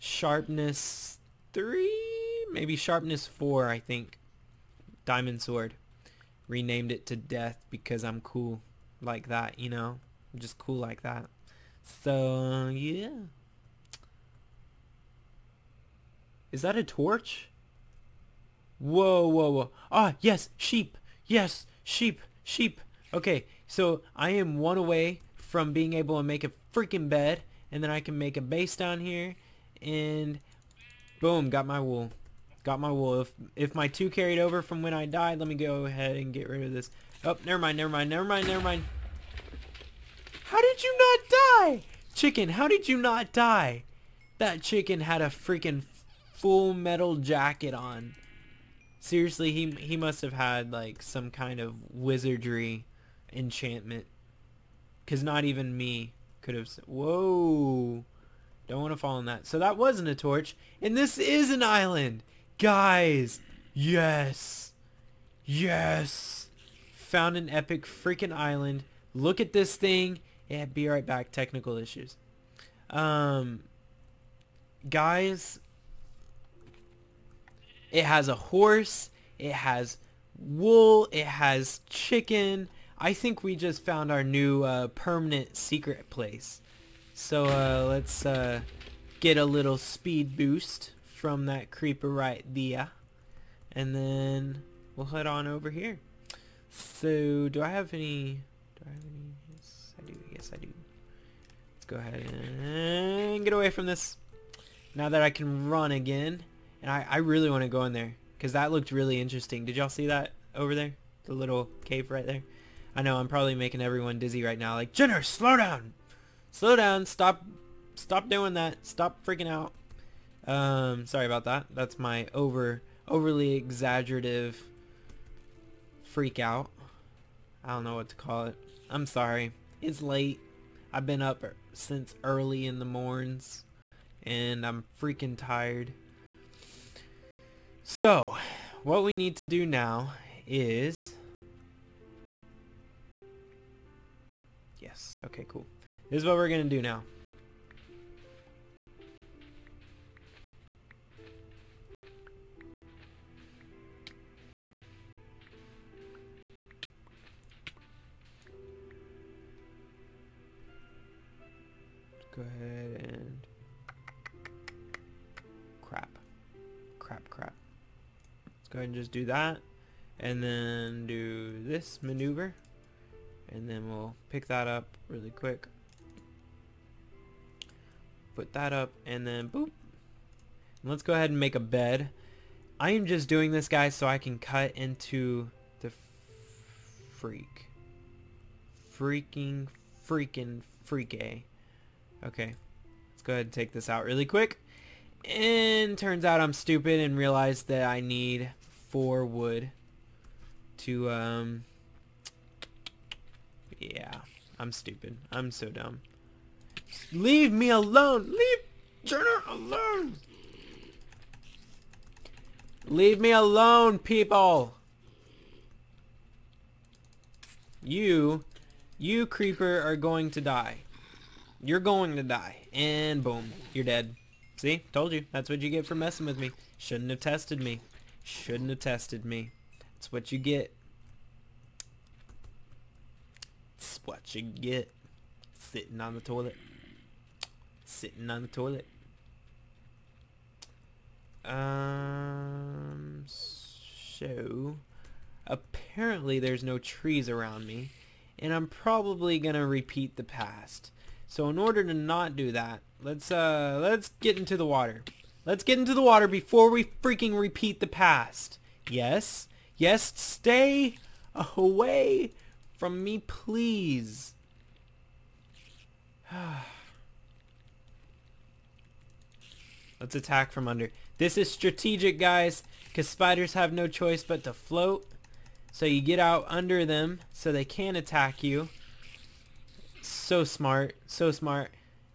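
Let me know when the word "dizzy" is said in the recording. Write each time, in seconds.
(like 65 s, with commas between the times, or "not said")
114 s.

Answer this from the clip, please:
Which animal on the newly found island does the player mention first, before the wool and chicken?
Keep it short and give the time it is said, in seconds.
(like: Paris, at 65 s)
Horse, at 78 s.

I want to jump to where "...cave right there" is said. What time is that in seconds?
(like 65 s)
111 s.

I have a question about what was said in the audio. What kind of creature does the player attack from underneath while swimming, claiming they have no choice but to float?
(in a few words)
Spiders.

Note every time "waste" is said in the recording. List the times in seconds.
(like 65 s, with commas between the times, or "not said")
not said.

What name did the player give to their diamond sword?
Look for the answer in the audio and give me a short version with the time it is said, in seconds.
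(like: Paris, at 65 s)
Death, at 7 s.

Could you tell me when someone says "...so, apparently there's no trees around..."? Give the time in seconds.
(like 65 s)
243 s.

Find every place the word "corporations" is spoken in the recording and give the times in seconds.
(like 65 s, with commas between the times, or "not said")
not said.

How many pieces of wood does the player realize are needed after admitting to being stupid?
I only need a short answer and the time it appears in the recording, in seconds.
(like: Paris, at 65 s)
4, at 198 s.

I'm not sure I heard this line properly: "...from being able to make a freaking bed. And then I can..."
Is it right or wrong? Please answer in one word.
right.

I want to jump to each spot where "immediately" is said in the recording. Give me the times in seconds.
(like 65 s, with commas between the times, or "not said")
not said.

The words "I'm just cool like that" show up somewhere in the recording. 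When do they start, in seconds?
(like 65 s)
10 s.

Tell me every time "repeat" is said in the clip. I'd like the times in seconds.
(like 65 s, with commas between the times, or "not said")
249 s, 257 s.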